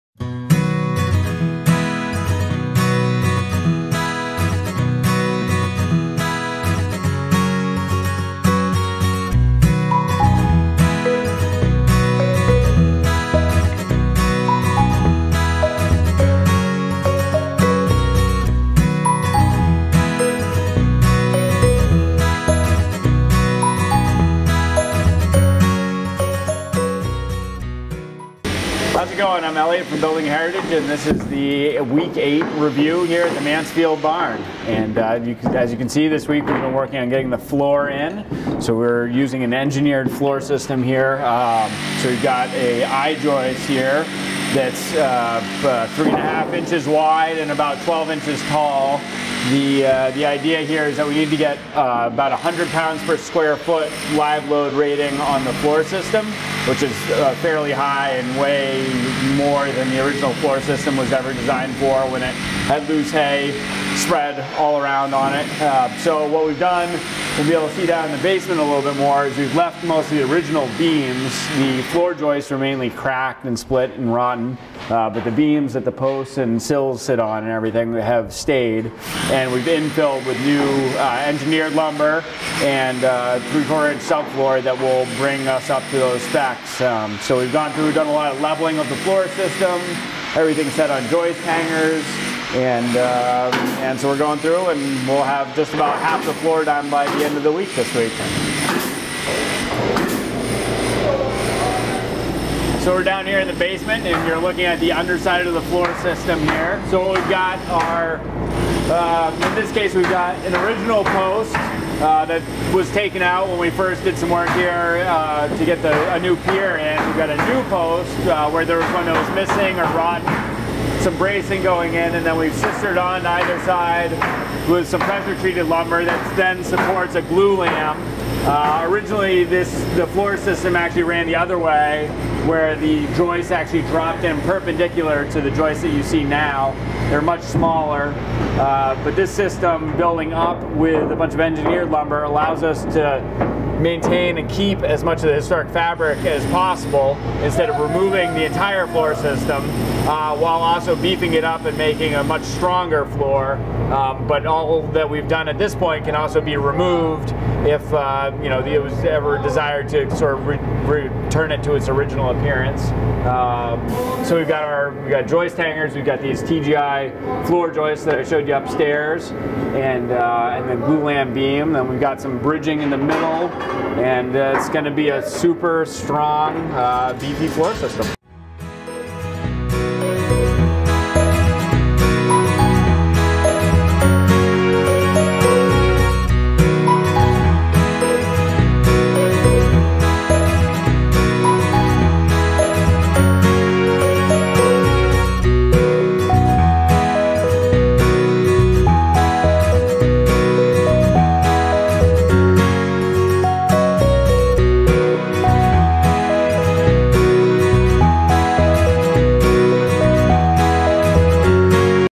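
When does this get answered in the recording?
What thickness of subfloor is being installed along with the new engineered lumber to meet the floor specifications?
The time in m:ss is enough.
1:23.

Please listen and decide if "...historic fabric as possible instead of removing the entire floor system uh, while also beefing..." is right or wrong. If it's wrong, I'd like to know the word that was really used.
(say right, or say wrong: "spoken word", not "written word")
right.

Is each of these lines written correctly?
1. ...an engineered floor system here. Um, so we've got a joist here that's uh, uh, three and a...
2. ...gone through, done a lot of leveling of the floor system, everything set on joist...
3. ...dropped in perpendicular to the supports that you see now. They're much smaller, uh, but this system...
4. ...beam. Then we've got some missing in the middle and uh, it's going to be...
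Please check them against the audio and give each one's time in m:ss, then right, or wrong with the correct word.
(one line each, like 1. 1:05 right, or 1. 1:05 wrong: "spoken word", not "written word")
1. 0:39 right
2. 1:27 right
3. 2:13 wrong: "joists", not "supports"
4. 2:51 wrong: "bridging", not "missing".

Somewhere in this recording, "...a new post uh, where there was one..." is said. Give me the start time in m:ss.
1:57.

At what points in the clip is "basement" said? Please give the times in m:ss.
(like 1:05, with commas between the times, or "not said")
1:08, 1:43.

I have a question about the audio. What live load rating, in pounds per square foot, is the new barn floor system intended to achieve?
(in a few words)
100 pounds per square foot.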